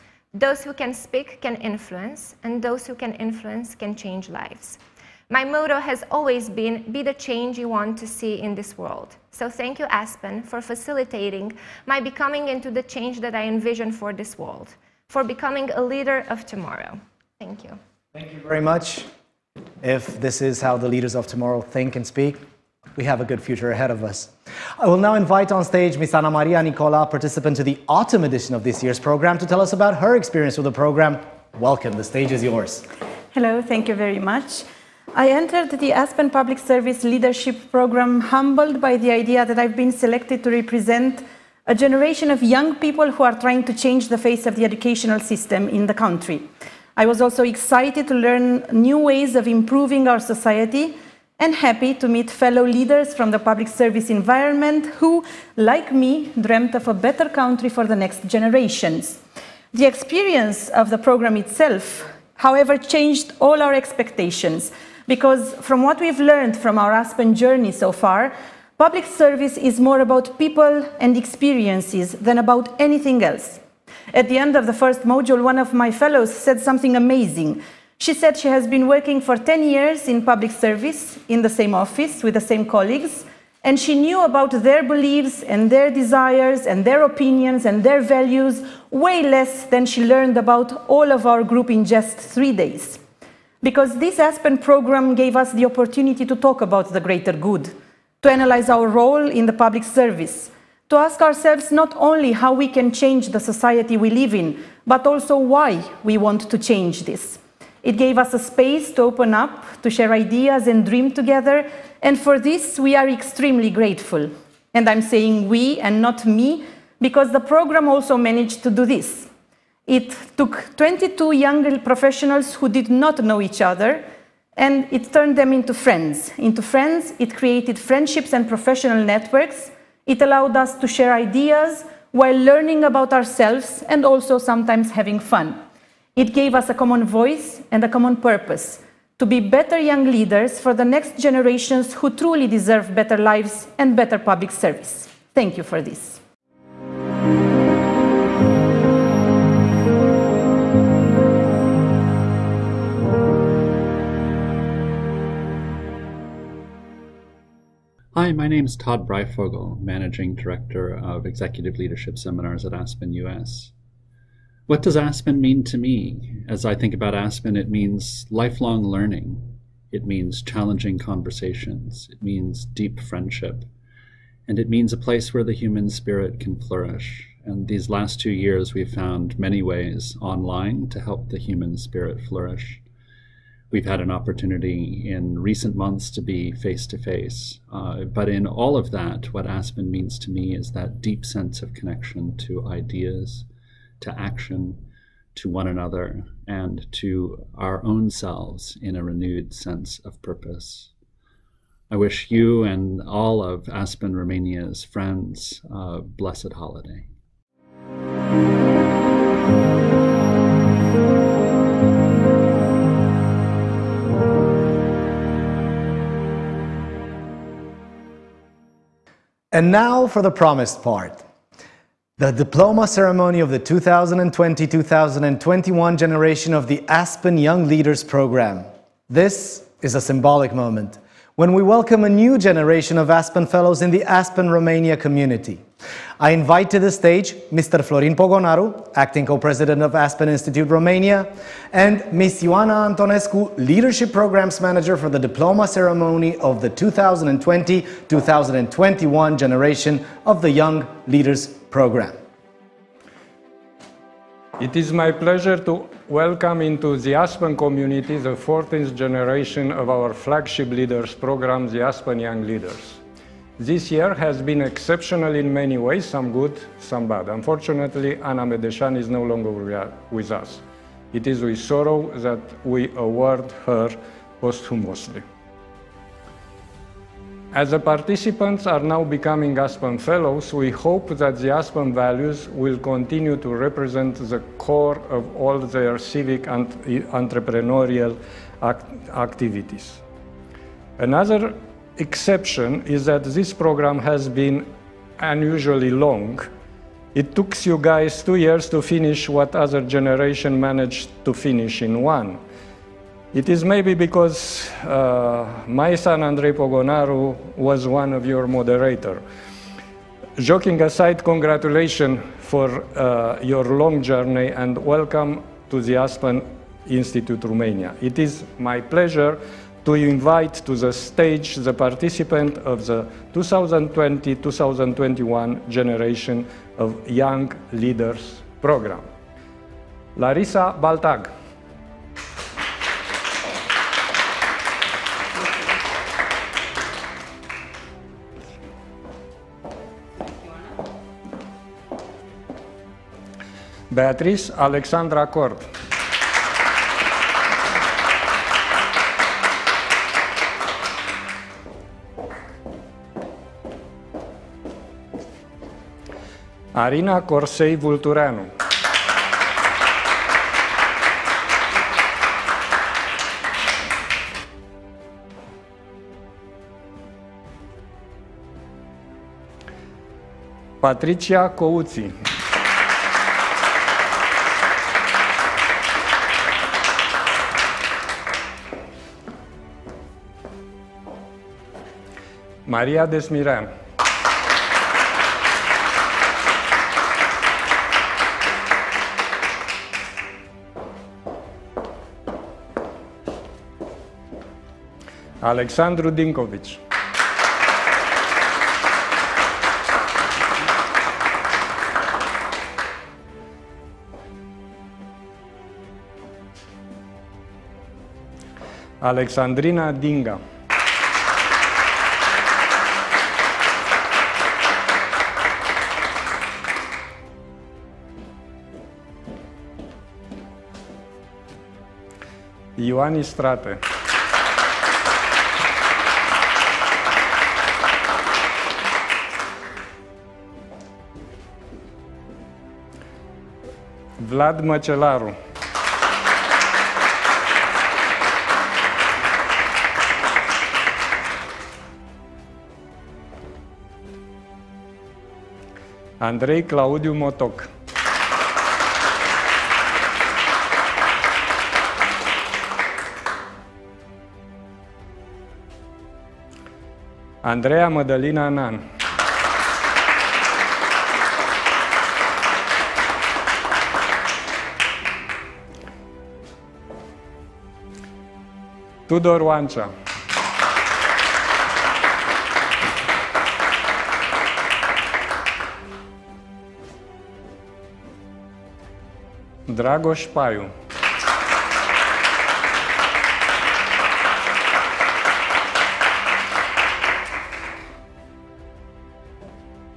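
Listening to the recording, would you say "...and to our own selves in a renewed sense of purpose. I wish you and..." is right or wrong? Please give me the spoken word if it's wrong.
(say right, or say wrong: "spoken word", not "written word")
right.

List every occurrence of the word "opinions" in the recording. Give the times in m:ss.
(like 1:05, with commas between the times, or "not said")
1:27.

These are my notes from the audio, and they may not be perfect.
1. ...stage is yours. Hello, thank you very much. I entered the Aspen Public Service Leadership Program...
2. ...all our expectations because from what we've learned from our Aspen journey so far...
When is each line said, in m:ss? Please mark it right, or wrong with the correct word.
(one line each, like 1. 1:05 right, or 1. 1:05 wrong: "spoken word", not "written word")
1. 0:32 right
2. 1:03 right.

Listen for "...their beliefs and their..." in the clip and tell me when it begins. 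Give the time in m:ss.
1:24.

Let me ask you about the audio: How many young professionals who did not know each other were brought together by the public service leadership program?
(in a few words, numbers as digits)
22.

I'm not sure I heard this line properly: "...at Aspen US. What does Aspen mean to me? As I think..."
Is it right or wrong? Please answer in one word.
right.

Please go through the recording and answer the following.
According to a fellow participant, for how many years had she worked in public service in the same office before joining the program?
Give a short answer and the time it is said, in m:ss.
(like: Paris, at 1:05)
10, at 1:19.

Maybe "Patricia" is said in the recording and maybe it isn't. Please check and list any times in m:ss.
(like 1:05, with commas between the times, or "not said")
6:10.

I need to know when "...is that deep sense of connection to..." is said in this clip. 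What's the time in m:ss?
3:10.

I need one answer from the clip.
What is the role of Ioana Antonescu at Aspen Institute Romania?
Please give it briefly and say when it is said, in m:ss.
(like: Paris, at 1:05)
Leadership Programs Manager, at 4:03.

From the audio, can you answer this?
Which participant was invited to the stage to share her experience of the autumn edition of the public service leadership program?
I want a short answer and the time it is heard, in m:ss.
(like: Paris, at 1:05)
Ana Maria Nicola, at 0:26.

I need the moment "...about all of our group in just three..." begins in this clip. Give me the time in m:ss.
1:30.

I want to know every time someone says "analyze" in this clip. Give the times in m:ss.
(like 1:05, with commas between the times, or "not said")
1:38.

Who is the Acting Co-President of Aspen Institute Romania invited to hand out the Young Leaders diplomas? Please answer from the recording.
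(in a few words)
Florin Pogonaru.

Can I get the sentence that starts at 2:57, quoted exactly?
And these last two years, we've found many ways online to help the human spirit flourish.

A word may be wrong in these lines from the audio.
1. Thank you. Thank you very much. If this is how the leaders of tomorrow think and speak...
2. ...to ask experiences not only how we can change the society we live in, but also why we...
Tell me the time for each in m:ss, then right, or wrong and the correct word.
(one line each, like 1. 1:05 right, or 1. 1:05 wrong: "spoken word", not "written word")
1. 0:17 right
2. 1:40 wrong: "ourselves", not "experiences".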